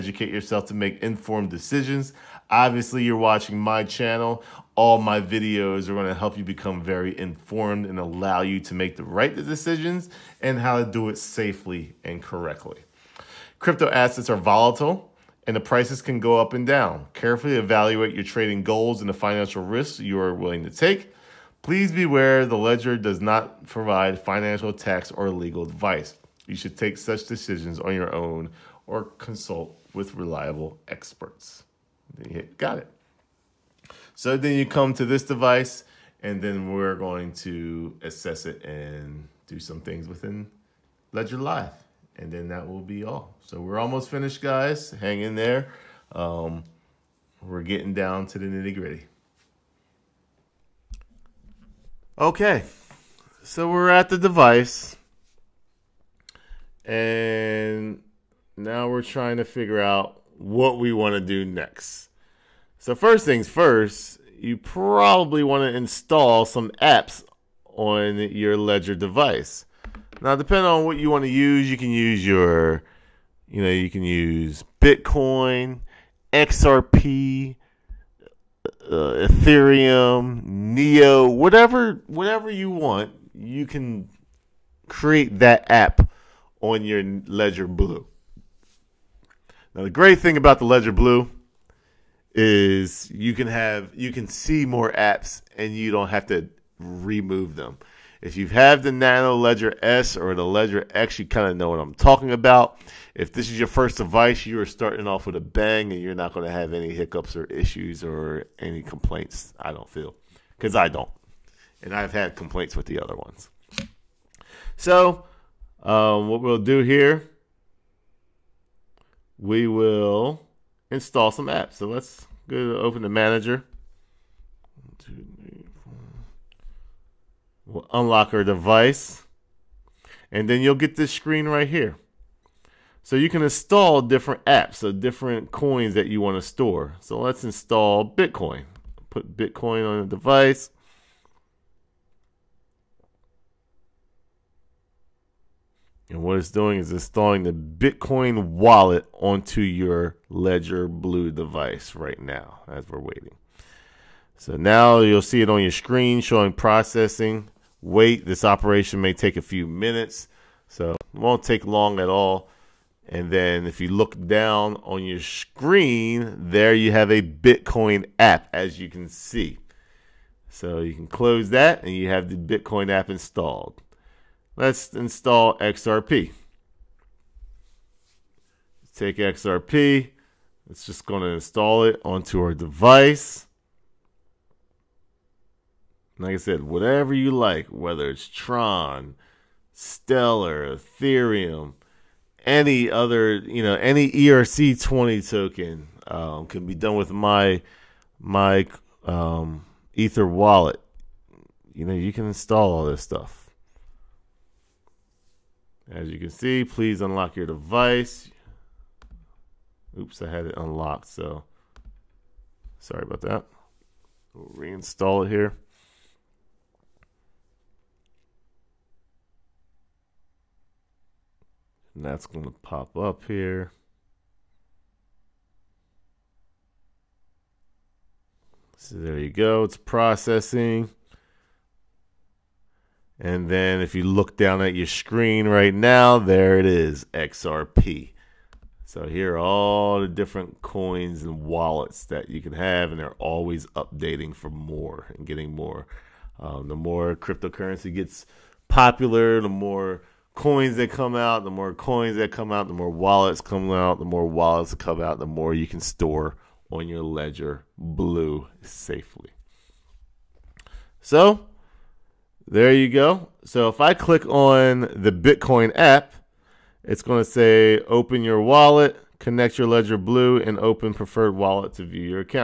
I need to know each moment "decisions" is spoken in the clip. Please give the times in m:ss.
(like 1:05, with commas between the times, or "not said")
0:01, 0:09, 0:27.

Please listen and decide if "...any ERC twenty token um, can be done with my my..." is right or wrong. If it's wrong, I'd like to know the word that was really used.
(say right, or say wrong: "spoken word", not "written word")
right.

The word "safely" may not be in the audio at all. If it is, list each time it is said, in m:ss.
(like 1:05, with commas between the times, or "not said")
0:11, 4:18.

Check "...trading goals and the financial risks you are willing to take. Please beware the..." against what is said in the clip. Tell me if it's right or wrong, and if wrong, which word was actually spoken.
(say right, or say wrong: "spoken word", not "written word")
right.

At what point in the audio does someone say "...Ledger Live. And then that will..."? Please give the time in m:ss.
0:41.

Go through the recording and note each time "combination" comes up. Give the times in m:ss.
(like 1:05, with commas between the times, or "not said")
not said.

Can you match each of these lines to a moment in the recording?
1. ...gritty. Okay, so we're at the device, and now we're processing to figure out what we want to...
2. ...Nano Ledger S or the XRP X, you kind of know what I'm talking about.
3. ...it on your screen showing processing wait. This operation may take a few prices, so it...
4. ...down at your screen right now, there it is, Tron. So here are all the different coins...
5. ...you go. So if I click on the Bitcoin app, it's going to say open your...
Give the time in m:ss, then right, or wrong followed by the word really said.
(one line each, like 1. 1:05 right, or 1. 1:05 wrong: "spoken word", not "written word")
1. 0:48 wrong: "trying", not "processing"
2. 1:38 wrong: "Ledger", not "XRP"
3. 2:35 wrong: "minutes", not "prices"
4. 3:54 wrong: "XRP", not "Tron"
5. 4:22 right.